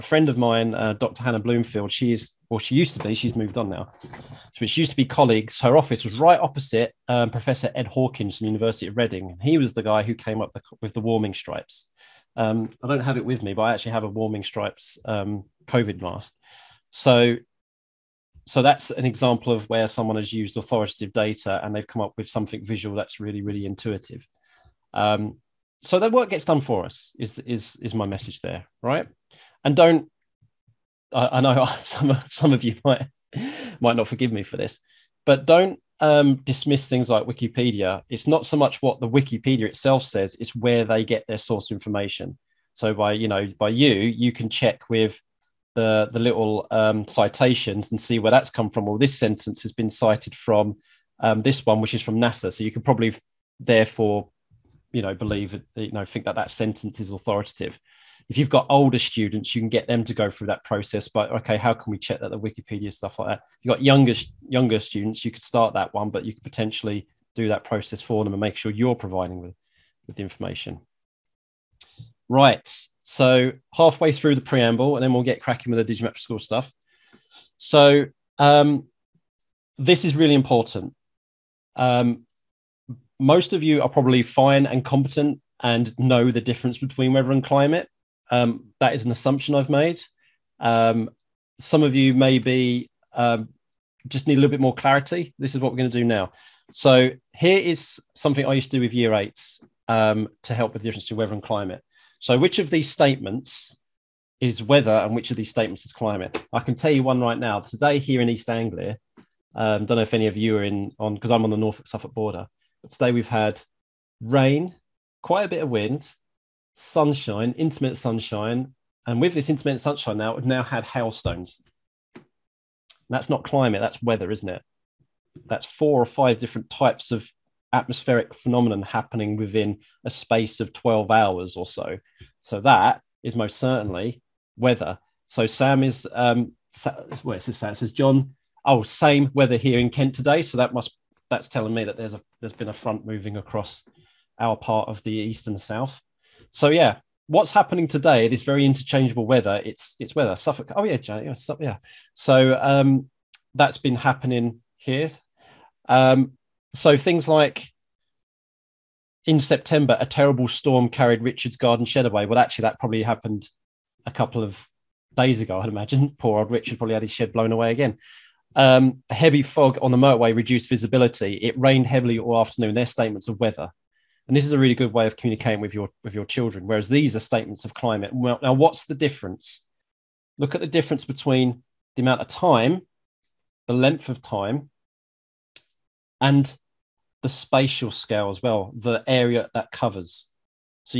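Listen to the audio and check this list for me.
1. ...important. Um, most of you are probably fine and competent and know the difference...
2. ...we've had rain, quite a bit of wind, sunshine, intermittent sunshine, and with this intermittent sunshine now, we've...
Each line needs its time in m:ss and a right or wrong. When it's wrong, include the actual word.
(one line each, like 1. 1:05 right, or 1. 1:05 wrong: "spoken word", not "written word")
1. 1:20 right
2. 1:53 right.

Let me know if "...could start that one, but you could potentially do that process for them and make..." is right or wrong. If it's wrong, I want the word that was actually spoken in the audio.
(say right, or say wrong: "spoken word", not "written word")
right.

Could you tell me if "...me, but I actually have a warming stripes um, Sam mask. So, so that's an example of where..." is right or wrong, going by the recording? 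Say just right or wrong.
wrong.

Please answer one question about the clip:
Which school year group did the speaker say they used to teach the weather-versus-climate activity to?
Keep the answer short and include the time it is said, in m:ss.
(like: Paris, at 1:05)
Year 8, at 1:38.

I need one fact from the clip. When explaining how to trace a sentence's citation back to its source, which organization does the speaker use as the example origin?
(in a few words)
NASA.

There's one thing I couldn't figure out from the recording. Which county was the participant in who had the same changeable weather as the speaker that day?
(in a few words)
Kent.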